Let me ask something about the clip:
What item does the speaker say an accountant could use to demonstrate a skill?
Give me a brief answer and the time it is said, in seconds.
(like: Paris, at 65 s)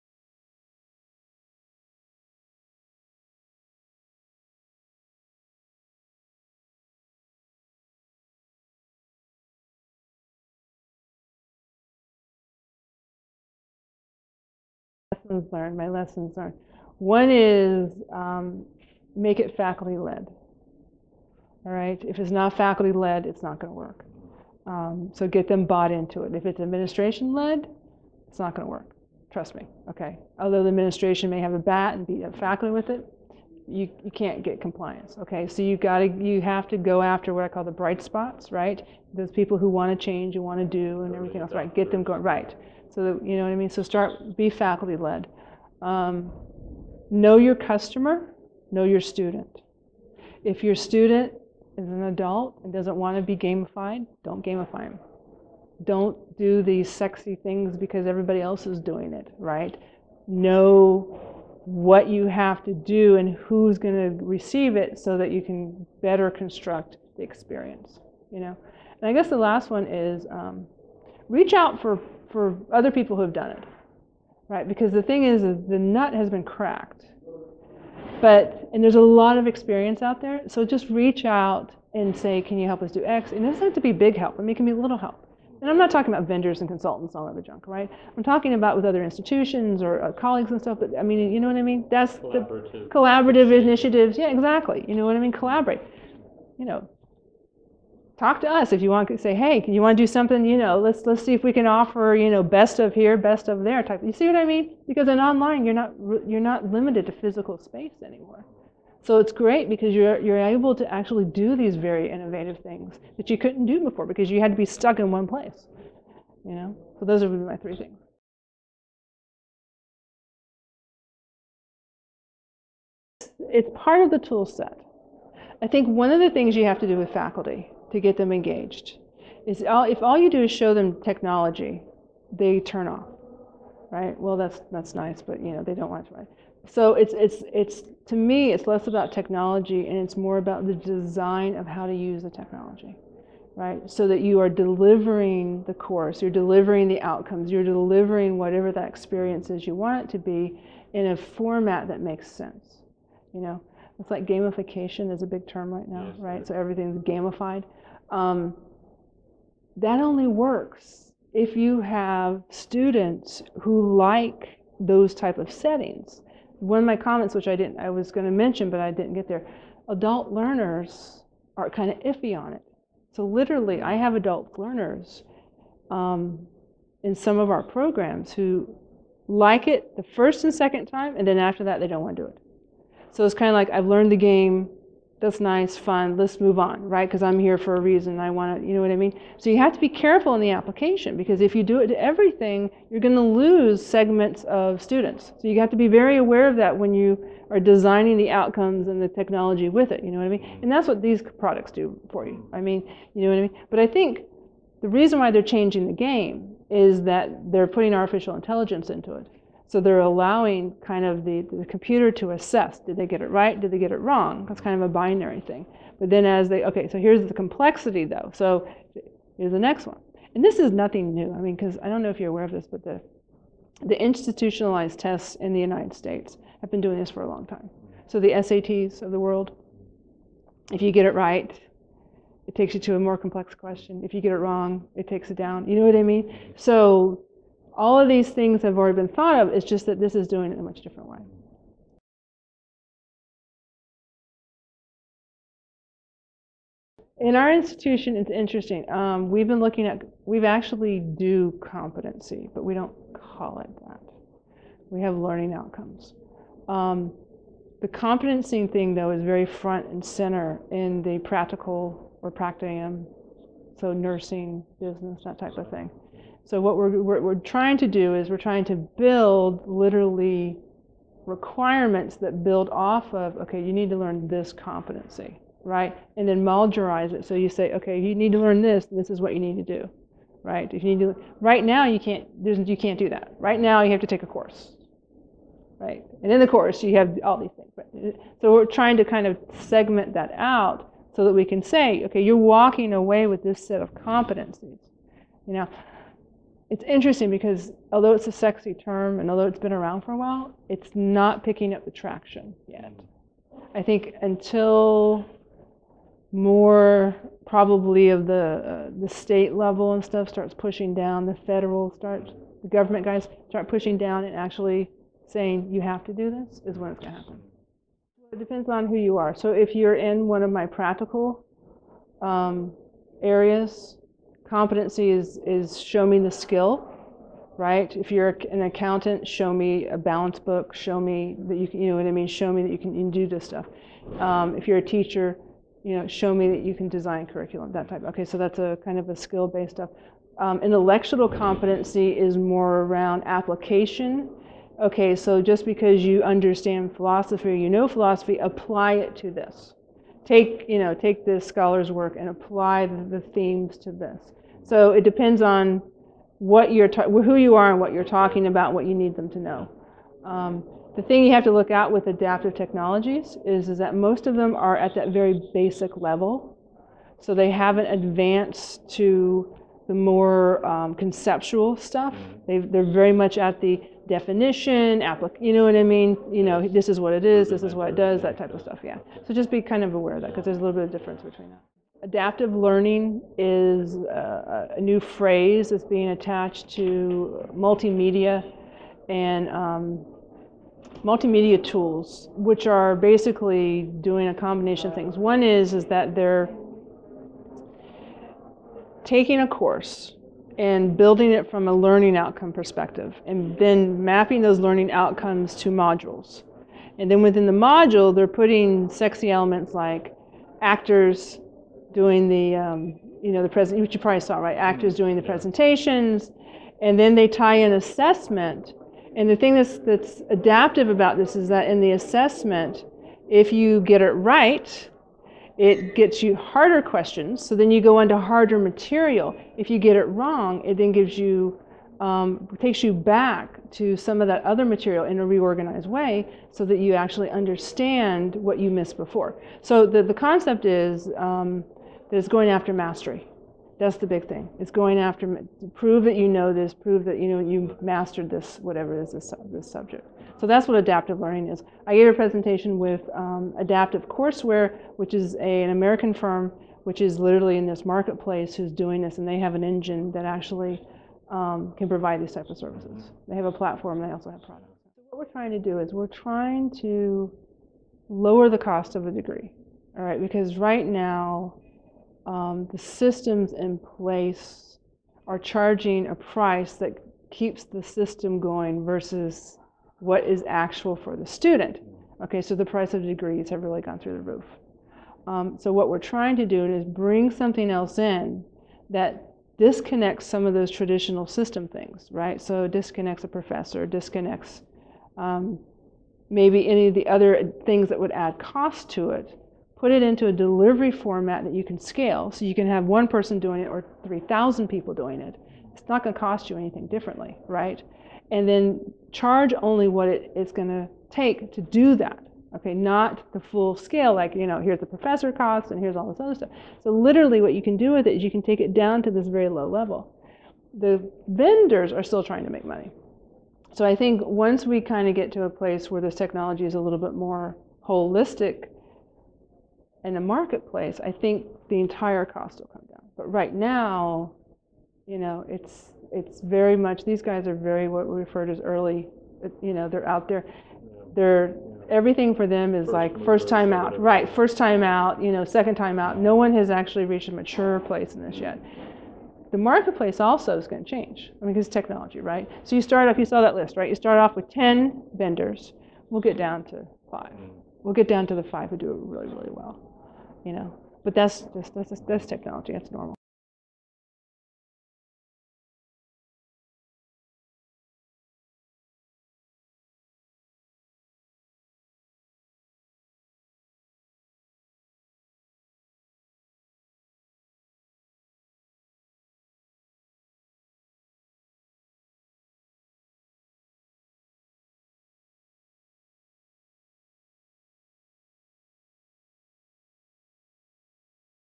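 A balance book, at 329 s.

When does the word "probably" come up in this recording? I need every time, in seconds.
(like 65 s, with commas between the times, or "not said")
307 s, 413 s.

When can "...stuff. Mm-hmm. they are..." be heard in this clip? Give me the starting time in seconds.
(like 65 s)
371 s.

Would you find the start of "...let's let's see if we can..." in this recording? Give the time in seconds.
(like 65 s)
100 s.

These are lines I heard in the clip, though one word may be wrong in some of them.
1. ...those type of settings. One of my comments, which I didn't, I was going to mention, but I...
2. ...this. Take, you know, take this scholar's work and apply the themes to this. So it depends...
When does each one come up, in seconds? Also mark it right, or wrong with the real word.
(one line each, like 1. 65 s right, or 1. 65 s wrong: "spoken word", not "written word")
1. 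164 s right
2. 349 s right.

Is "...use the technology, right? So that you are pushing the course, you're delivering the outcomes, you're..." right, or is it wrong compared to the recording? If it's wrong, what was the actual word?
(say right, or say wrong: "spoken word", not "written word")
wrong: "delivering", not "pushing".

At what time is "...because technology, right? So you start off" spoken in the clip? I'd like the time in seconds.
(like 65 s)
551 s.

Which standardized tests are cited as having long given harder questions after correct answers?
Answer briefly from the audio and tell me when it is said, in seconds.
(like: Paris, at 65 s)
SATs, at 228 s.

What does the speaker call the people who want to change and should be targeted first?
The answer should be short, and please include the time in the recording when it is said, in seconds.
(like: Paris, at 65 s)
Bright spots, at 37 s.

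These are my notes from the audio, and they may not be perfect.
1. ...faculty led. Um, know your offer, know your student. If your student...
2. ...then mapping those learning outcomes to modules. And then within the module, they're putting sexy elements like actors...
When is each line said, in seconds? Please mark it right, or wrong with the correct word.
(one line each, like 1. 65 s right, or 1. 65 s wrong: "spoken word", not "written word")
1. 44 s wrong: "customer", not "offer"
2. 403 s right.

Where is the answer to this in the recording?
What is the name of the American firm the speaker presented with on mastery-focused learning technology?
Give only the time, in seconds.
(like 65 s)
453 s.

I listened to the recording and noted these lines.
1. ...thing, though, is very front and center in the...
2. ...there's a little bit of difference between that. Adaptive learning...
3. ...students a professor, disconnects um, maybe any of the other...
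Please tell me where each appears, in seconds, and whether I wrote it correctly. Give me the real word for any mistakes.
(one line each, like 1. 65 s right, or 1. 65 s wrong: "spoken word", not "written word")
1. 258 s right
2. 380 s right
3. 492 s wrong: "disconnects", not "students".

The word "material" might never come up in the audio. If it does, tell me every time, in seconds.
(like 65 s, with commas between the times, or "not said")
428 s, 434 s.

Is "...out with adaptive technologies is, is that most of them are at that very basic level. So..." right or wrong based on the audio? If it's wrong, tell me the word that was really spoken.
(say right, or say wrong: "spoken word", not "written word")
right.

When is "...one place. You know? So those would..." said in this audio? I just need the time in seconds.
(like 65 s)
115 s.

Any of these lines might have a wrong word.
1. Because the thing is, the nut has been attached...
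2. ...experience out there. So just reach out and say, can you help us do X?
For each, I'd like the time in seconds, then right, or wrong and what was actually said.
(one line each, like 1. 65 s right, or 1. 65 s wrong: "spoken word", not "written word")
1. 74 s wrong: "cracked", not "attached"
2. 79 s right.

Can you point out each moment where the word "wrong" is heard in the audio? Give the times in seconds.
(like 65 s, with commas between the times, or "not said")
214 s, 234 s, 430 s.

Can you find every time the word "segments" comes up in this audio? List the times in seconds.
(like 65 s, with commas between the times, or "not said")
193 s, 289 s.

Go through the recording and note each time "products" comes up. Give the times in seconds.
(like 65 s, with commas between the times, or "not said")
201 s, 464 s.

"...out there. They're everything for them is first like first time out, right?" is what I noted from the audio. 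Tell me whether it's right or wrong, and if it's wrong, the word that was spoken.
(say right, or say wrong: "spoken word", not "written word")
right.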